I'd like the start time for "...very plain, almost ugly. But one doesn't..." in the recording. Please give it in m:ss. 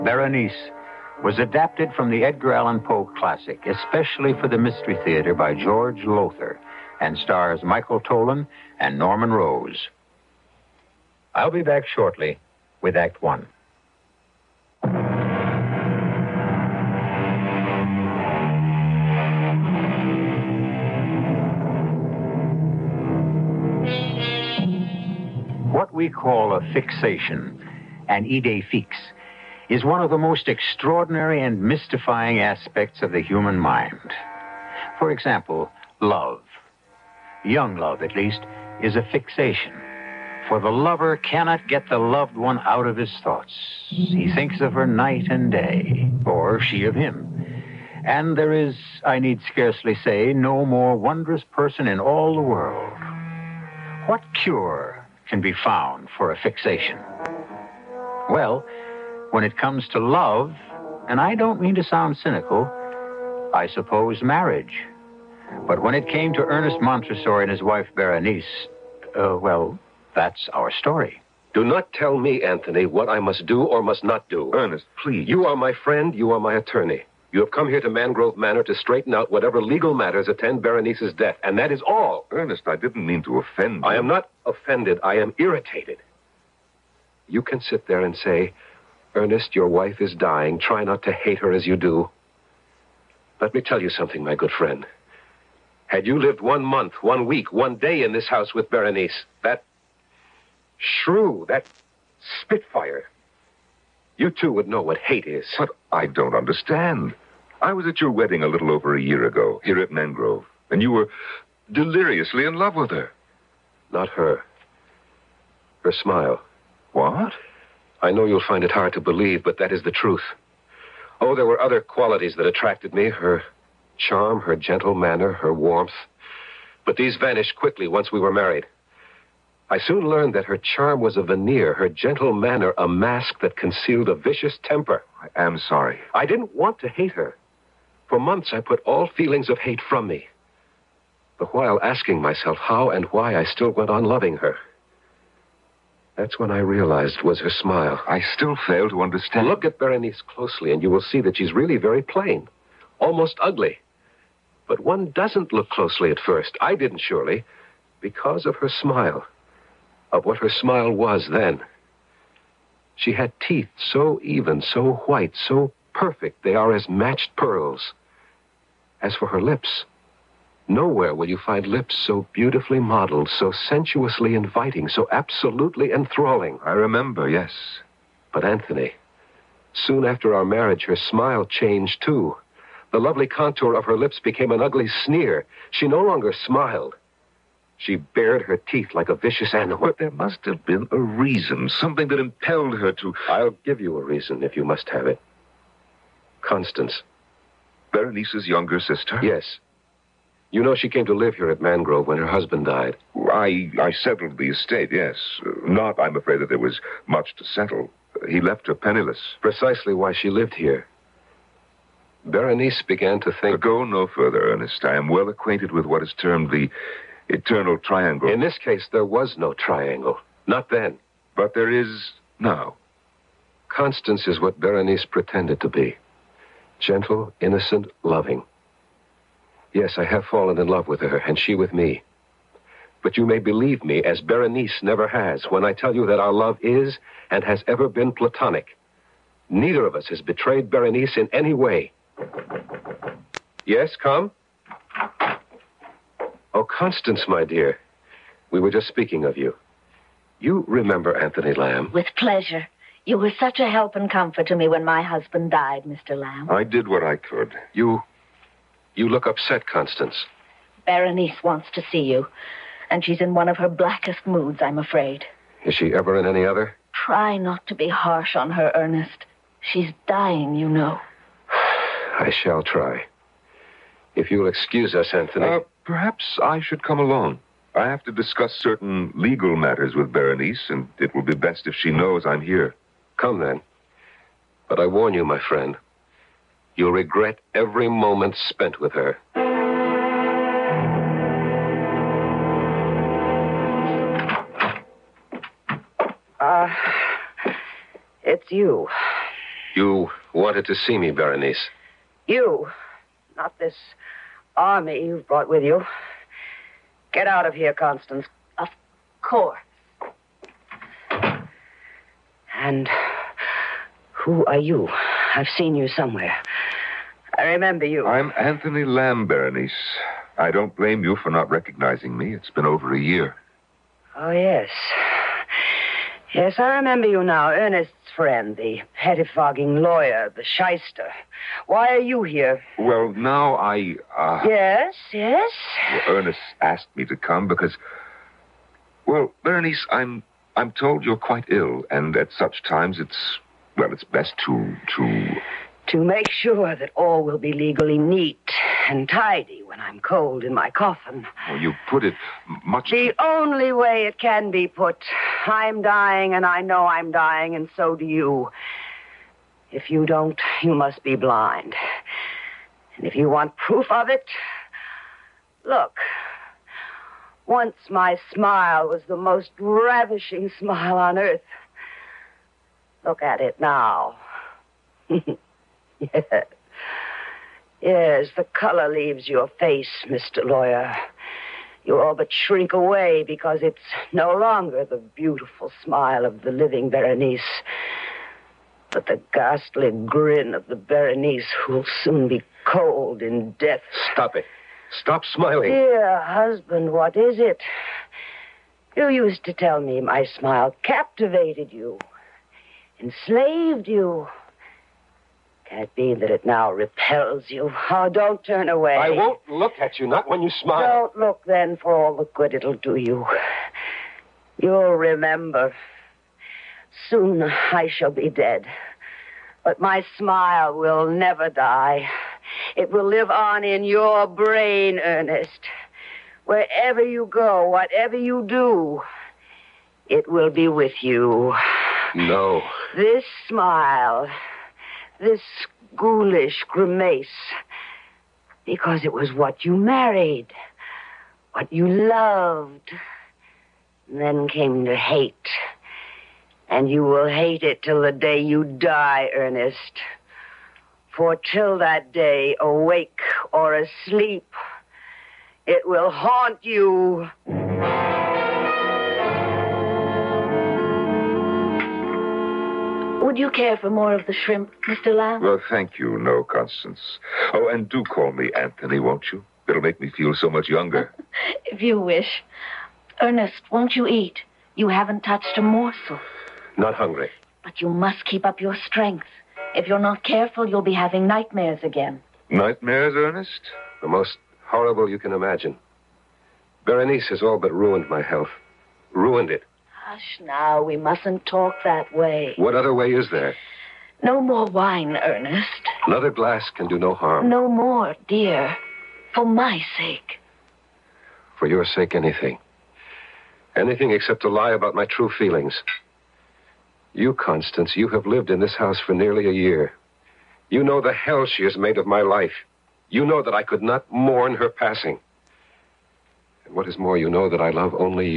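2:31.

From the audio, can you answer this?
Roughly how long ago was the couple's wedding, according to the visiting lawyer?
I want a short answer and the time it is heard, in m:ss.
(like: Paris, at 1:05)
a little over a year, at 1:48.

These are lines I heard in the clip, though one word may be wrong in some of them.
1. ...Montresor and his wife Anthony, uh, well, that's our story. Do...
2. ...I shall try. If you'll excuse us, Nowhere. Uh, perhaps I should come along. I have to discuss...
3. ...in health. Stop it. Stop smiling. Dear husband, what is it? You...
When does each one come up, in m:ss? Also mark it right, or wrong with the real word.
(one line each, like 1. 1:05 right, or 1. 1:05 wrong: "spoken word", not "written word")
1. 1:06 wrong: "Berenice", not "Anthony"
2. 4:31 wrong: "Anthony", not "Nowhere"
3. 6:33 wrong: "death", not "health".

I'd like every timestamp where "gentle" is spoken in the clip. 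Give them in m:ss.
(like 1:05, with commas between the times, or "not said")
2:04, 2:11, 3:46.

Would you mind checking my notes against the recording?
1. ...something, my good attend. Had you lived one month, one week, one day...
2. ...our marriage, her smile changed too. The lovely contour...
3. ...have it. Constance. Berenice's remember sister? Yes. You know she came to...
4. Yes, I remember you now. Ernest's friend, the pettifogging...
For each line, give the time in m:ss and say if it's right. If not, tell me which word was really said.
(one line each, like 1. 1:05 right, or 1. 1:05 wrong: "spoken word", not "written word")
1. 1:33 wrong: "friend", not "attend"
2. 3:00 right
3. 3:14 wrong: "younger", not "remember"
4. 5:26 right.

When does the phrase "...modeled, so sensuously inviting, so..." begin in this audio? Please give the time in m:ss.
2:52.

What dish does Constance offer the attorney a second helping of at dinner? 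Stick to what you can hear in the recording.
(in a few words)
shrimp.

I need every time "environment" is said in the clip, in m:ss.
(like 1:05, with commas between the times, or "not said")
not said.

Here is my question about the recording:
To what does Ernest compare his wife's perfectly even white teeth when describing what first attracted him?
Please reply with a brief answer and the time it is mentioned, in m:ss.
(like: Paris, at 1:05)
matched pearls, at 2:46.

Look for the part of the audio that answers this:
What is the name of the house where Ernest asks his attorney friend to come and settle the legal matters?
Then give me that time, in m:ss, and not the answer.
1:17.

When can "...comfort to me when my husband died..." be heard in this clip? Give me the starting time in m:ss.
4:14.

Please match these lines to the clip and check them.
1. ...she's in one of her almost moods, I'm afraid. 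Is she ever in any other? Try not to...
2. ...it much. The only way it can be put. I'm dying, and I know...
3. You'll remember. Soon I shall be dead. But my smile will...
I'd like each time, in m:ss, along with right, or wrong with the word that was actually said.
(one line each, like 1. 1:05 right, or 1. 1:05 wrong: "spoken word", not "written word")
1. 4:23 wrong: "blackest", not "almost"
2. 5:52 right
3. 6:54 right.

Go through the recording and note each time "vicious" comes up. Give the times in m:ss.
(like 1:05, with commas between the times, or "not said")
2:14, 3:09.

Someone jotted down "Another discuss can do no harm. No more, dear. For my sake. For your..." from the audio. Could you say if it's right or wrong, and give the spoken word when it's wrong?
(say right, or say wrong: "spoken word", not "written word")
wrong: "glass", not "discuss".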